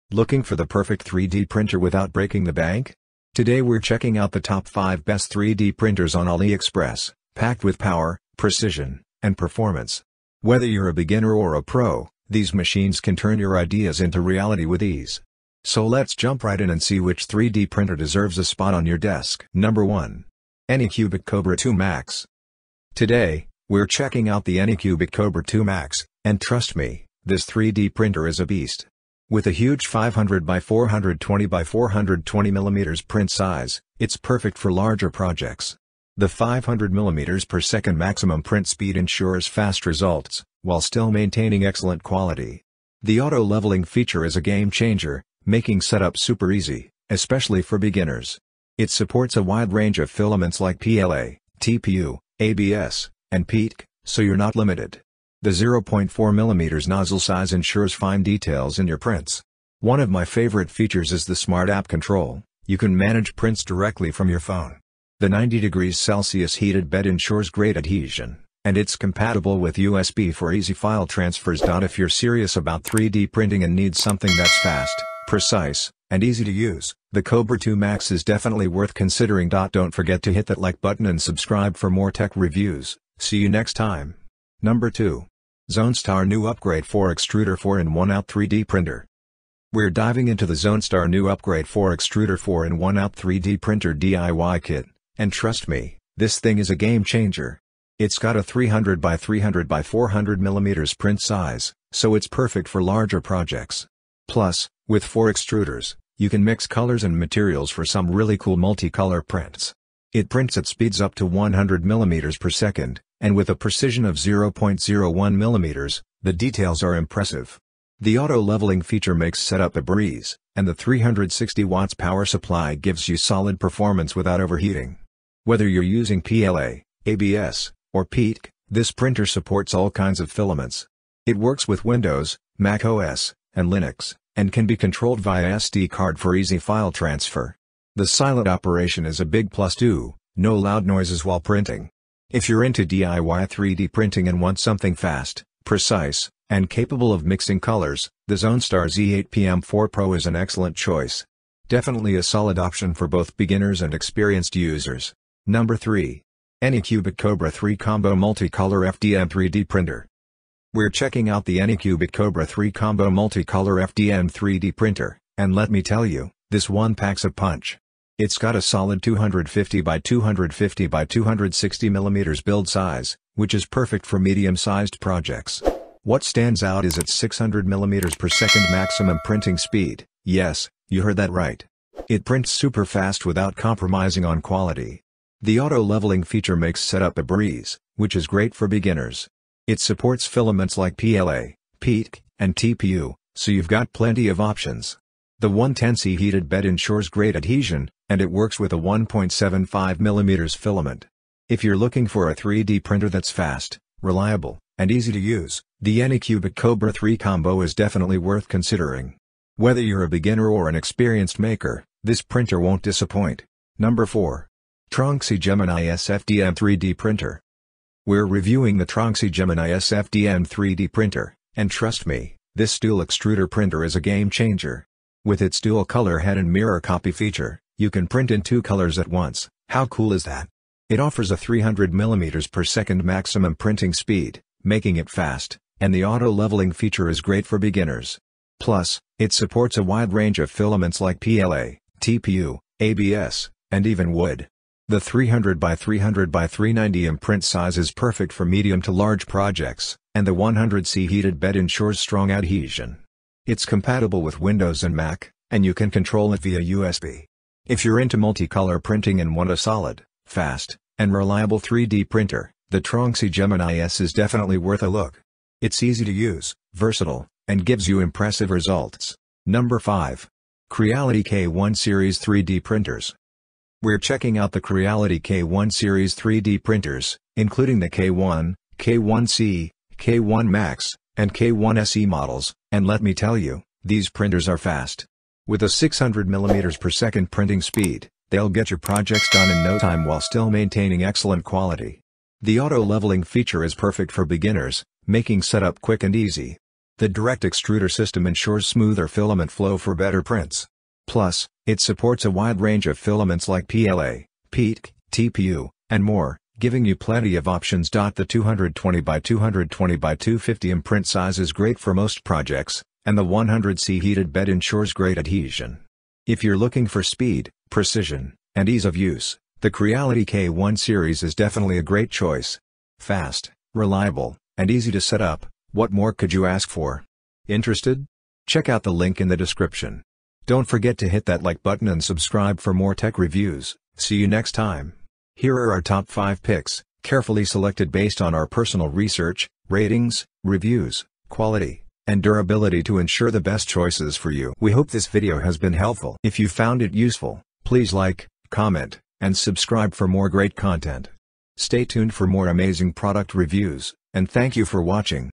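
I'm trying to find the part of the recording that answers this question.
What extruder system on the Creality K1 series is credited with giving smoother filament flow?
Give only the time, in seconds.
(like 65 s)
297 s.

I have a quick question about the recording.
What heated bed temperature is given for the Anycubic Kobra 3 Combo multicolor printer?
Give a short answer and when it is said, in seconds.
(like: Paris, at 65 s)
110C, at 195 s.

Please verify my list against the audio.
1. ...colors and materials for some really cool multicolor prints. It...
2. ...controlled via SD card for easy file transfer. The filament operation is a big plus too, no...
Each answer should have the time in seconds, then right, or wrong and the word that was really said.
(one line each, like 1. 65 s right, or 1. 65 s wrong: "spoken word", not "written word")
1. 106 s right
2. 134 s wrong: "silent", not "filament".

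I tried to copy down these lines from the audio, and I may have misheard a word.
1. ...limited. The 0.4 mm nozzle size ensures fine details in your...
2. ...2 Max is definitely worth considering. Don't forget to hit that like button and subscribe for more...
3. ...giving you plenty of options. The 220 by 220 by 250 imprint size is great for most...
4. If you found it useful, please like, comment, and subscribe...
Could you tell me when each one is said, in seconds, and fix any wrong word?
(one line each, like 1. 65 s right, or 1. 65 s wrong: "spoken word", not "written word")
1. 54 s right
2. 77 s right
3. 306 s right
4. 346 s right.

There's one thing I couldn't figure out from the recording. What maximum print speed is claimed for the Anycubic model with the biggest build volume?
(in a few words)
500 mm per second.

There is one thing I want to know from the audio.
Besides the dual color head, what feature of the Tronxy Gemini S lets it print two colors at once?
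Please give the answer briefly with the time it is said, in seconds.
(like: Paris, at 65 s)
mirror copy, at 226 s.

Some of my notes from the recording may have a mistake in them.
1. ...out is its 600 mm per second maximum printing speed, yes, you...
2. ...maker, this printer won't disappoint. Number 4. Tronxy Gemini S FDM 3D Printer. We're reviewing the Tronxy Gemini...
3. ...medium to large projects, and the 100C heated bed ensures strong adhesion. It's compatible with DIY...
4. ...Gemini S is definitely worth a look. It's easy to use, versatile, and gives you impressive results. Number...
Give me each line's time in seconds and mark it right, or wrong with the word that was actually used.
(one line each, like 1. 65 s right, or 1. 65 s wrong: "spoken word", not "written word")
1. 176 s right
2. 211 s right
3. 248 s wrong: "Windows", not "DIY"
4. 263 s right.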